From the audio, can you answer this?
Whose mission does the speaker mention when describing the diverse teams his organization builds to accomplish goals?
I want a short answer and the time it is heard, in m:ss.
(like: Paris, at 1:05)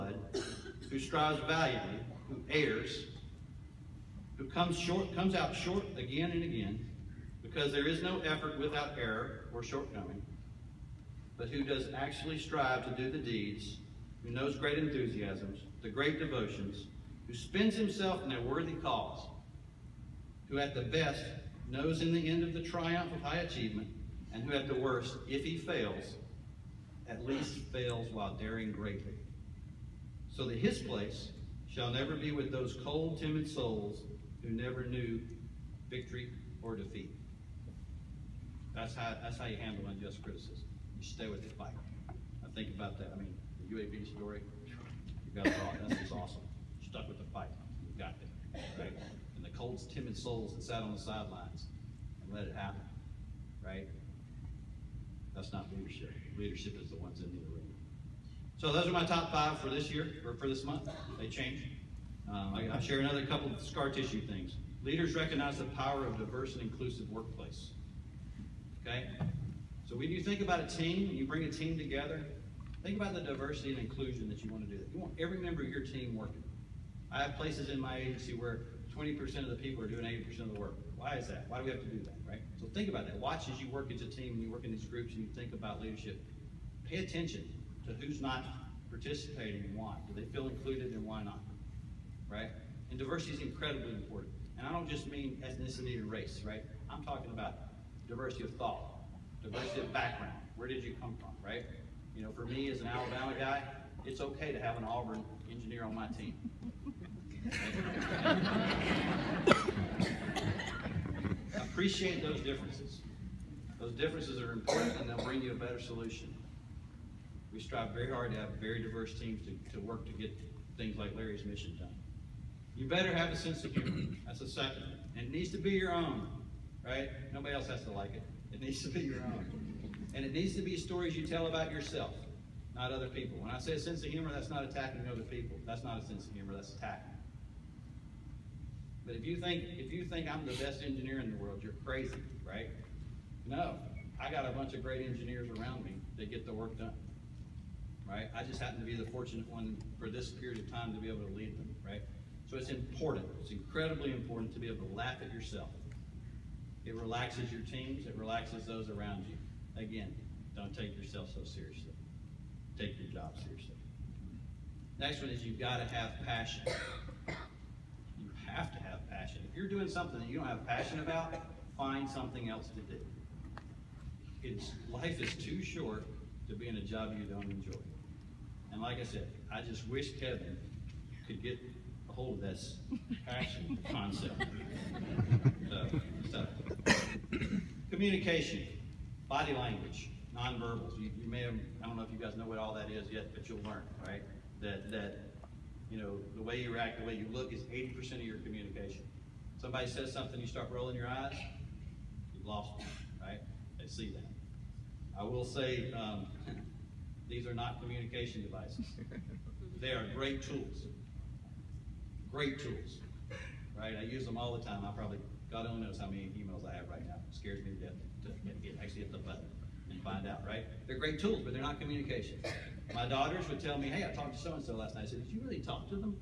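Larry, at 2:01.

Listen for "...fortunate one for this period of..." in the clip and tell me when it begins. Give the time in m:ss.
2:29.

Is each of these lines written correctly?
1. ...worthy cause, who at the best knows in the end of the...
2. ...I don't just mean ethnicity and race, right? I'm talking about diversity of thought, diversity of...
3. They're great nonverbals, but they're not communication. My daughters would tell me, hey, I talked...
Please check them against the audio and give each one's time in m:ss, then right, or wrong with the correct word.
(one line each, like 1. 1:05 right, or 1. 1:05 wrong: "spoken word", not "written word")
1. 0:18 right
2. 1:34 right
3. 3:40 wrong: "tools", not "nonverbals".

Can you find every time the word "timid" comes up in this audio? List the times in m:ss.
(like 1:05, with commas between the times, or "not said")
0:33, 0:49.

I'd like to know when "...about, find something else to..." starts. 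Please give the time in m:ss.
2:50.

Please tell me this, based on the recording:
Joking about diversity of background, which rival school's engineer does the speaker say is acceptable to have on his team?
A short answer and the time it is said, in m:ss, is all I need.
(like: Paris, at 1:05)
Auburn, at 1:44.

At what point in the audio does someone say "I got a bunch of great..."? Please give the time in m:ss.
2:24.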